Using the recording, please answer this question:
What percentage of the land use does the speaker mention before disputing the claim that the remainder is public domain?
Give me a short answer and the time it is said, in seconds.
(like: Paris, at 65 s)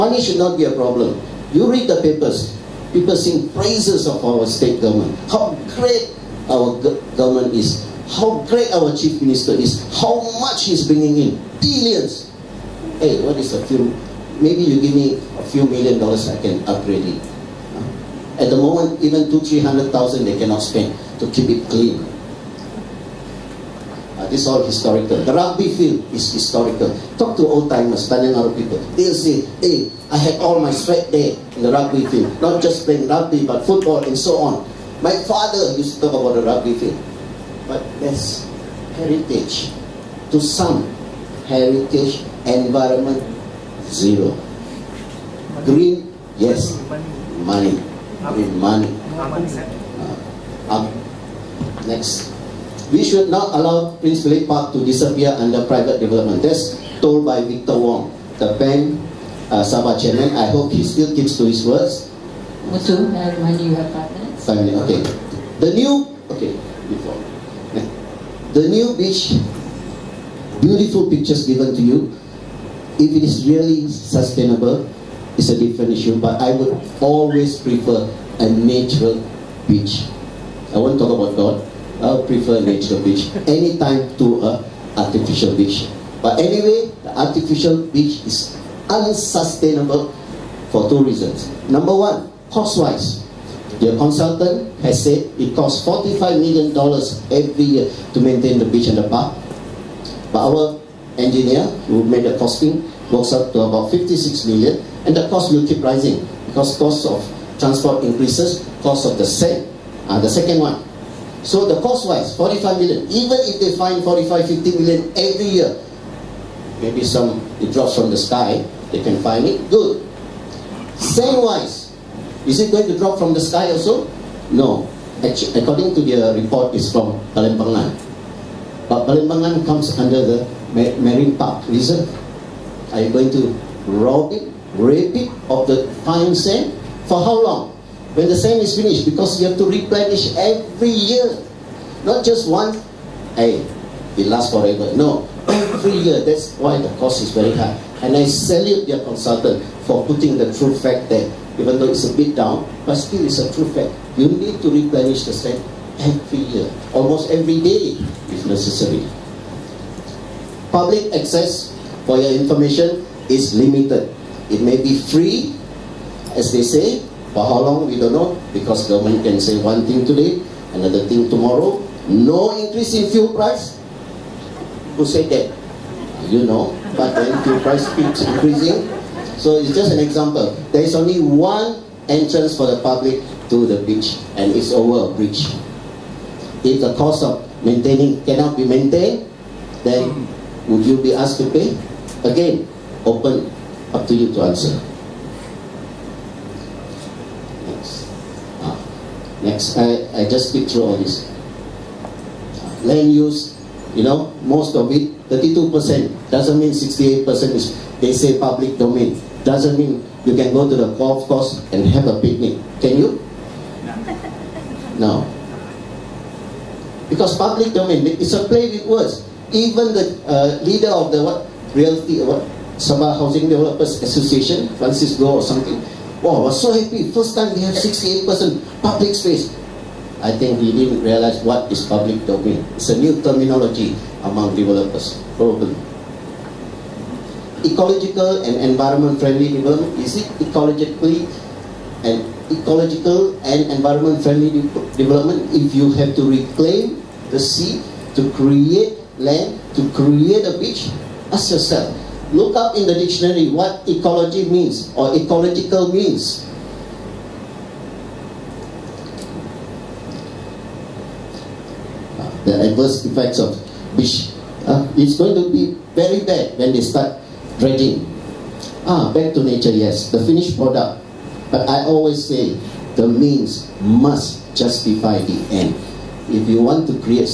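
32%, at 205 s.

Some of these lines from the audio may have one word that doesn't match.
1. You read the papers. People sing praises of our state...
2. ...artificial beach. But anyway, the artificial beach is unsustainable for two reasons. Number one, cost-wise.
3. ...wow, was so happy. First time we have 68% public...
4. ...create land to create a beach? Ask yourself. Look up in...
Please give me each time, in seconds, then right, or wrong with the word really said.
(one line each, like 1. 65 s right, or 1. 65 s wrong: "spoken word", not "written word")
1. 1 s right
2. 84 s right
3. 226 s right
4. 248 s right.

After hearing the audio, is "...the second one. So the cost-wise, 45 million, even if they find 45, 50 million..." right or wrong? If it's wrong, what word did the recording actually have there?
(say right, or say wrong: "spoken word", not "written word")
right.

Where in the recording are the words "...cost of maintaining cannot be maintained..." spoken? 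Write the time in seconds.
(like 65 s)
186 s.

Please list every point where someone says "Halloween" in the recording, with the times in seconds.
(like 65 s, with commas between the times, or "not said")
not said.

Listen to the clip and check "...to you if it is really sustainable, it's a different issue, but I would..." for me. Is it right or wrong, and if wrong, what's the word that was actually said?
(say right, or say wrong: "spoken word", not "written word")
right.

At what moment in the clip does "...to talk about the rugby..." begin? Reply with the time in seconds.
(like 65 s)
35 s.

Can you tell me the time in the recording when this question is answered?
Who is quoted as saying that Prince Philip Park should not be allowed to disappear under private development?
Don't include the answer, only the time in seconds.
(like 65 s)
57 s.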